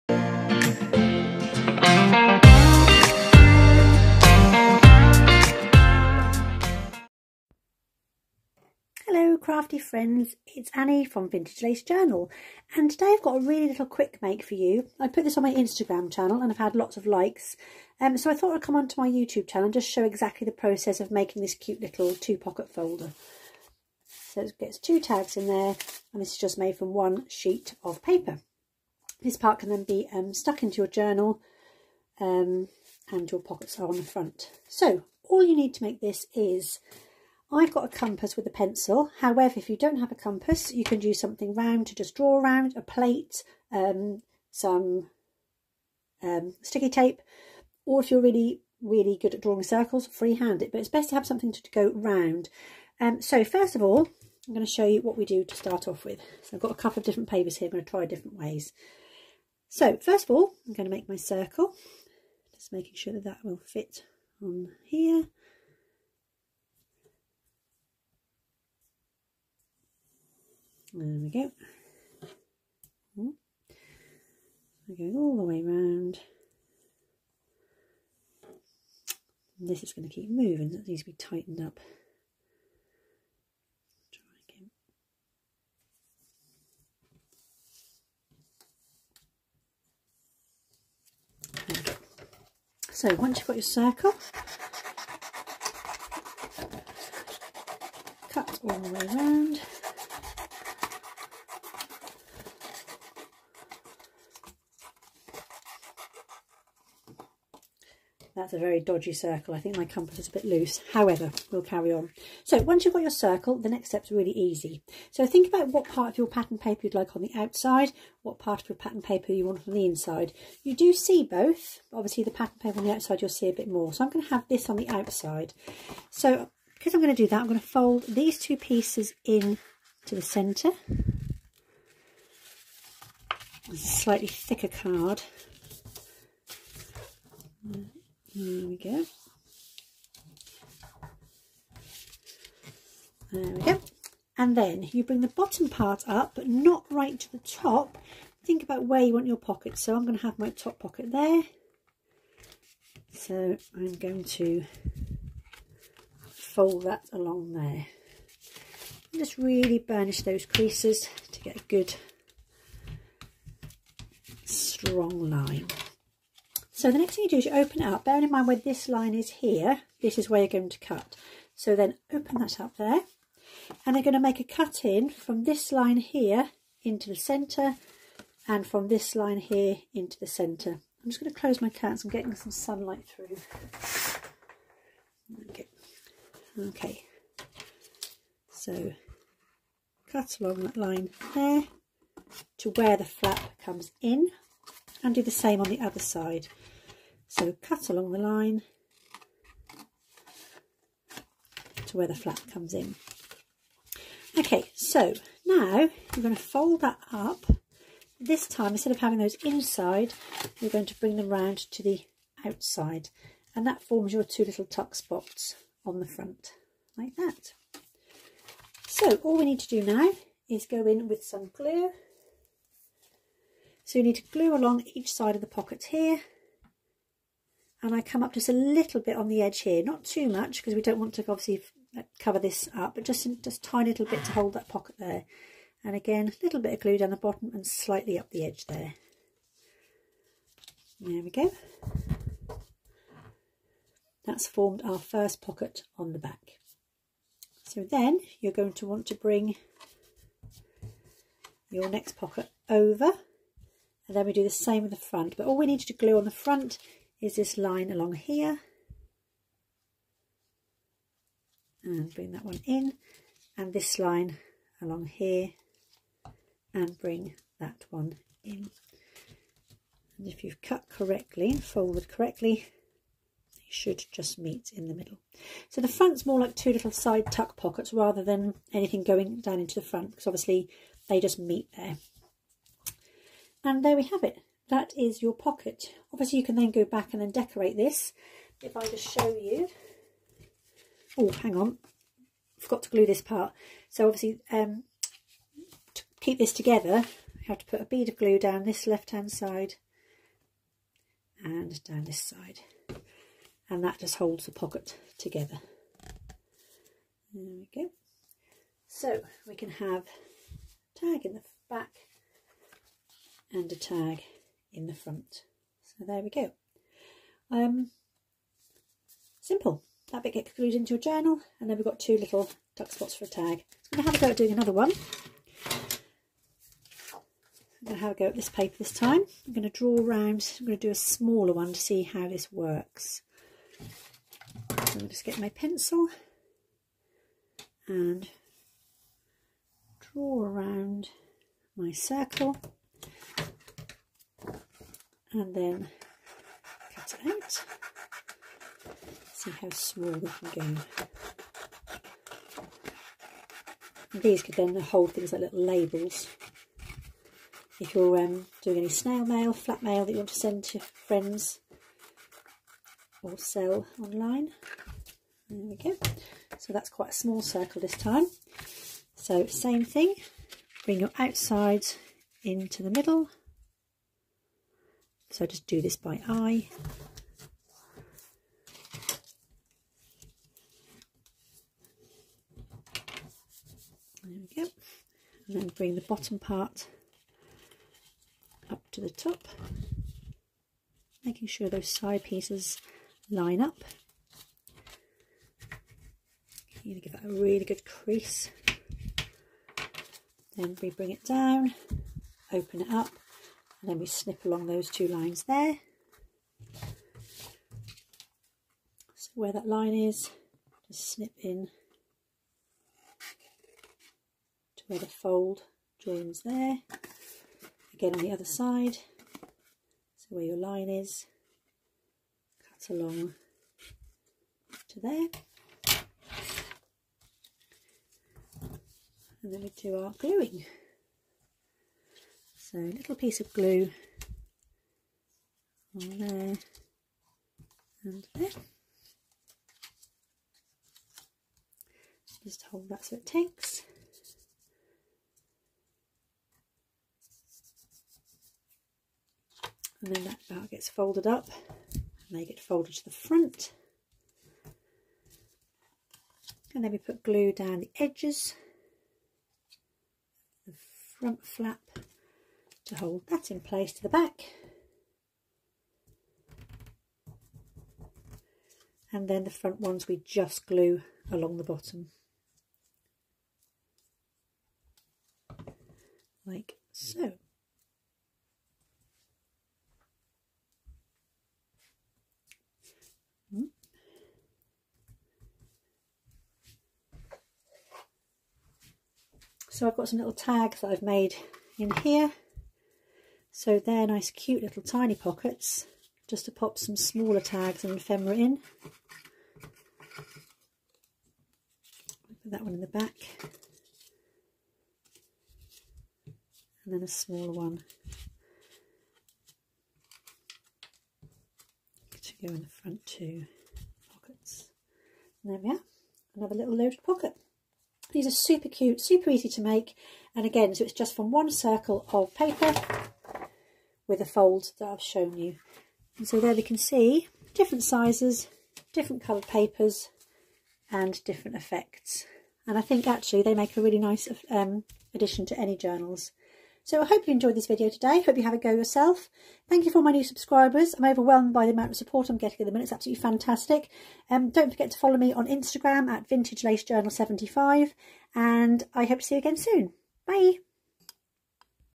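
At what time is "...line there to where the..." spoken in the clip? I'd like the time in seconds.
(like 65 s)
190 s.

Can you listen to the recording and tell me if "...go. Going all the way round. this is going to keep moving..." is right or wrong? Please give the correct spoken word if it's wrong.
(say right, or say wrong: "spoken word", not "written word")
right.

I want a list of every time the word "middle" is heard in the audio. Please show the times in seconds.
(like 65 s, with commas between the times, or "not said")
274 s, 372 s.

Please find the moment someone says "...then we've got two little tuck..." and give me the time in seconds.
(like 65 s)
321 s.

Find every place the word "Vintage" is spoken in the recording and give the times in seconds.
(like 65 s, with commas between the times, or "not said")
11 s, 546 s.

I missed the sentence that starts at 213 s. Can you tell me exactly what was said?
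And that forms your two little tuck spots on the front, like that.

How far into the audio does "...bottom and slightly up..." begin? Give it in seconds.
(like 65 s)
237 s.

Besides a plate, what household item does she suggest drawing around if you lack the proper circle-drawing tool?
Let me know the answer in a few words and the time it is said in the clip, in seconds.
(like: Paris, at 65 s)
sticky tape, at 46 s.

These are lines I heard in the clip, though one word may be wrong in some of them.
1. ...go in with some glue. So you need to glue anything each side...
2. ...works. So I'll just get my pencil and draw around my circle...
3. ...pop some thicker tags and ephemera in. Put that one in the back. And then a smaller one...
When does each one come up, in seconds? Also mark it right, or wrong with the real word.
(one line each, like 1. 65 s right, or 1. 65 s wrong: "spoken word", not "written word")
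1. 220 s wrong: "along", not "anything"
2. 332 s right
3. 496 s wrong: "smaller", not "thicker".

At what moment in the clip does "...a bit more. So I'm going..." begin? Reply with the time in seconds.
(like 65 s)
123 s.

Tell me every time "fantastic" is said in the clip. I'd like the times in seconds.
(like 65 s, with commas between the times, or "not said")
543 s.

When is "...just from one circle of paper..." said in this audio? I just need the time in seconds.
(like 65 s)
520 s.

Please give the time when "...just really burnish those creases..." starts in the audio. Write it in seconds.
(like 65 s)
159 s.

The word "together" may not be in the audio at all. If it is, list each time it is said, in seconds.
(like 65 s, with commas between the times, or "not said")
296 s, 305 s.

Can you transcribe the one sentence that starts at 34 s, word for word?
So all you need to make this is I've got a compass with a pencil.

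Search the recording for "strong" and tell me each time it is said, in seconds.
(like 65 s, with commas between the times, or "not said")
164 s.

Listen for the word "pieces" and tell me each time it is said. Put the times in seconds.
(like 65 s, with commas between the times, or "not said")
128 s, 392 s, 433 s.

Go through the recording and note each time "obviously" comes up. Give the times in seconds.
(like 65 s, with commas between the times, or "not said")
121 s, 231 s, 280 s, 286 s, 294 s.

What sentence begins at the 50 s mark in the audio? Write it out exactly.
But it's best to have something to, to go round.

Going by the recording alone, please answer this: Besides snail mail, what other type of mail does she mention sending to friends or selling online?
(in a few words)
flat mail.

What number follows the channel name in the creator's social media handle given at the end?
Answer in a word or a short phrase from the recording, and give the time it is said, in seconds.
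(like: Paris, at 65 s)
75, at 547 s.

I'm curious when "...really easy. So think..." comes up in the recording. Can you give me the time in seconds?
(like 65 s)
114 s.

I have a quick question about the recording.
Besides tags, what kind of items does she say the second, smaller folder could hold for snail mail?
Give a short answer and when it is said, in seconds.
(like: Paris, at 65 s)
little labels, at 355 s.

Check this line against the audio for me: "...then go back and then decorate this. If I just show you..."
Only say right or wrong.
right.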